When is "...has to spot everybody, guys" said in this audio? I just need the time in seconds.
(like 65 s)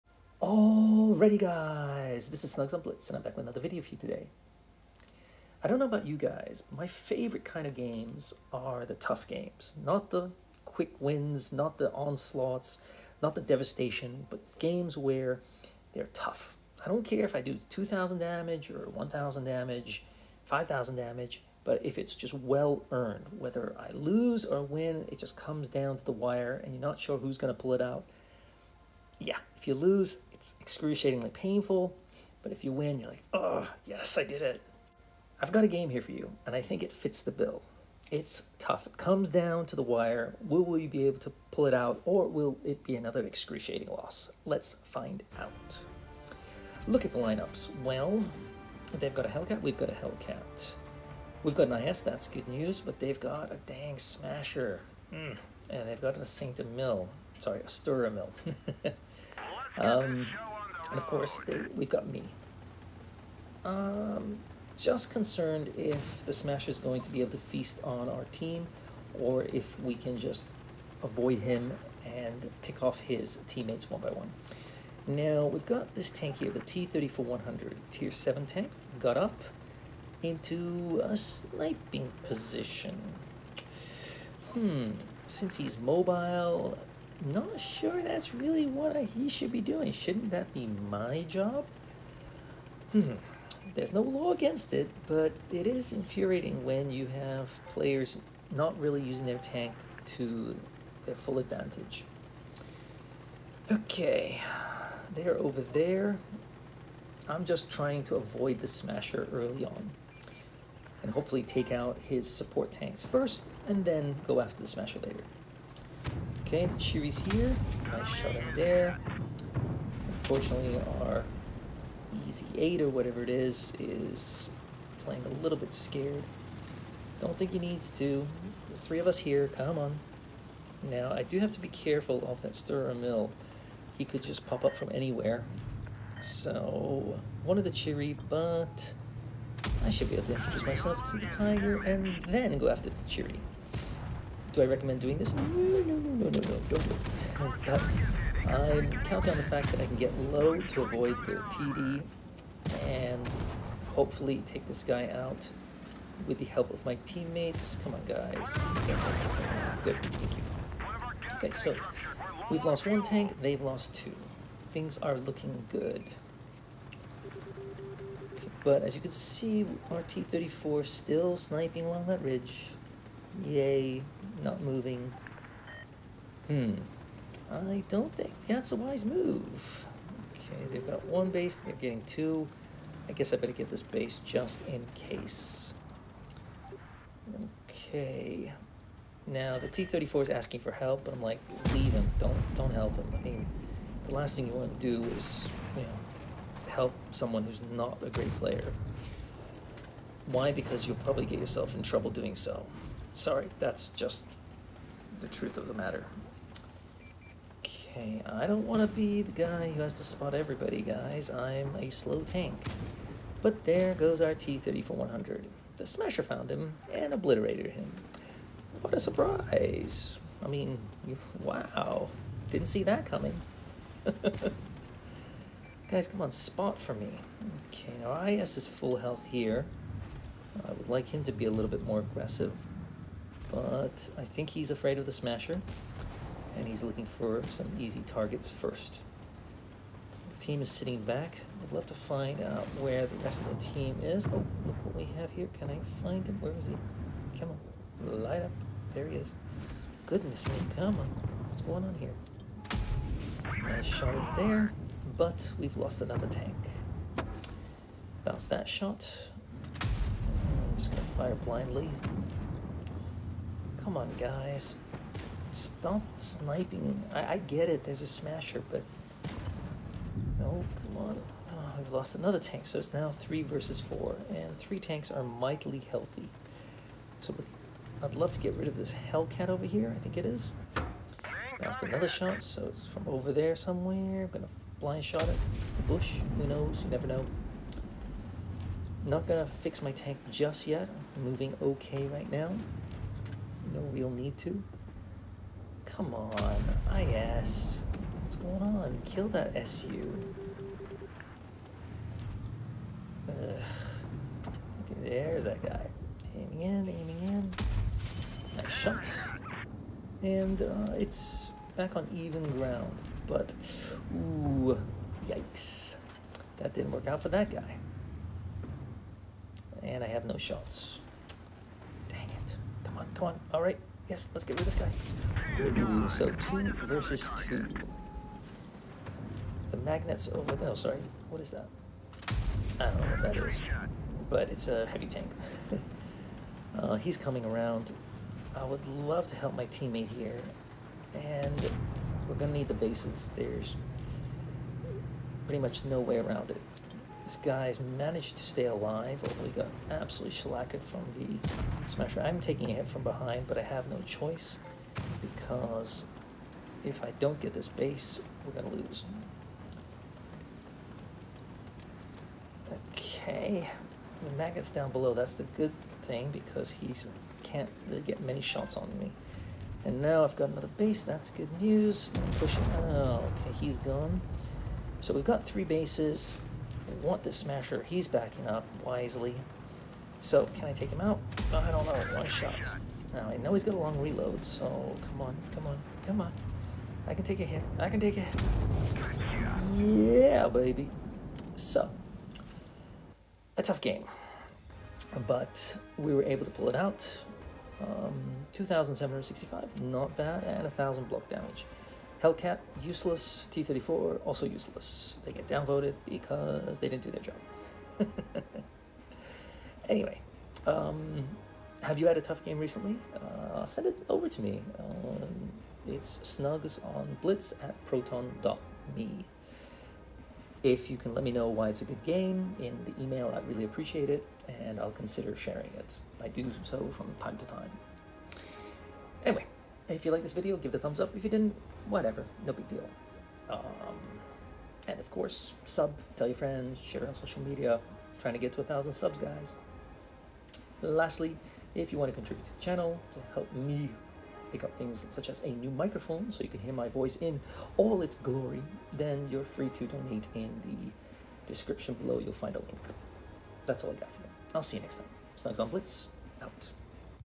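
209 s.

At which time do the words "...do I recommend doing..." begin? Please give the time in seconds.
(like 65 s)
144 s.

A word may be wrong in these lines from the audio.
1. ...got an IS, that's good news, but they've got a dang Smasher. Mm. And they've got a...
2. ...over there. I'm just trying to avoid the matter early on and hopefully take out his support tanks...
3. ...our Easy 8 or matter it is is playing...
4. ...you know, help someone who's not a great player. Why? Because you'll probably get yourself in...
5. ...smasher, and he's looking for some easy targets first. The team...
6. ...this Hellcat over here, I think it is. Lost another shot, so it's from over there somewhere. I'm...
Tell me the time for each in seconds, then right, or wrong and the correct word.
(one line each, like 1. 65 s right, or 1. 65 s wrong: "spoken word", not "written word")
1. 51 s right
2. 105 s wrong: "smasher", not "matter"
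3. 120 s wrong: "whatever", not "matter"
4. 195 s right
5. 235 s right
6. 278 s right.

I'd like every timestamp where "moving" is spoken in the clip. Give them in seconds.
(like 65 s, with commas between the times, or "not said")
174 s, 291 s.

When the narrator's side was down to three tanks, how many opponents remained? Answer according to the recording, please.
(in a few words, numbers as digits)
4.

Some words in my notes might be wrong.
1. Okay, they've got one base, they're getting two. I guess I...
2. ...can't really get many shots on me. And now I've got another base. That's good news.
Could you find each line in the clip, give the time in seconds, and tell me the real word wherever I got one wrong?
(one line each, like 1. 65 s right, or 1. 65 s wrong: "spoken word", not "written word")
1. 180 s right
2. 367 s right.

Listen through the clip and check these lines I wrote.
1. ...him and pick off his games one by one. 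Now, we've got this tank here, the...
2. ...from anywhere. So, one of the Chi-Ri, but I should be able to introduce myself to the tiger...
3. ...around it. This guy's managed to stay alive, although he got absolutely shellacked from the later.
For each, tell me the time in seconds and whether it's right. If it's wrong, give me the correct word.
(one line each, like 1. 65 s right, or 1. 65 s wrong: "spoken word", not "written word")
1. 71 s wrong: "teammates", not "games"
2. 134 s right
3. 346 s wrong: "smasher", not "later".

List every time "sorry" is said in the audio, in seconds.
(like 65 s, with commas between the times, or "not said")
57 s, 203 s, 330 s.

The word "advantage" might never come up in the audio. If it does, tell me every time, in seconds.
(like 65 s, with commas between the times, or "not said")
101 s.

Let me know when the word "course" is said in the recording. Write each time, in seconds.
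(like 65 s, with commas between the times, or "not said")
61 s, 435 s.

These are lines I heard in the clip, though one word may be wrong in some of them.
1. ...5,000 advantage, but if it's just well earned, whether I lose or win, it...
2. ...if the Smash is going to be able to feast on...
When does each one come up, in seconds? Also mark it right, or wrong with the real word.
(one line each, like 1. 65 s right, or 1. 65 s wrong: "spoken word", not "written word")
1. 20 s wrong: "damage", not "advantage"
2. 65 s right.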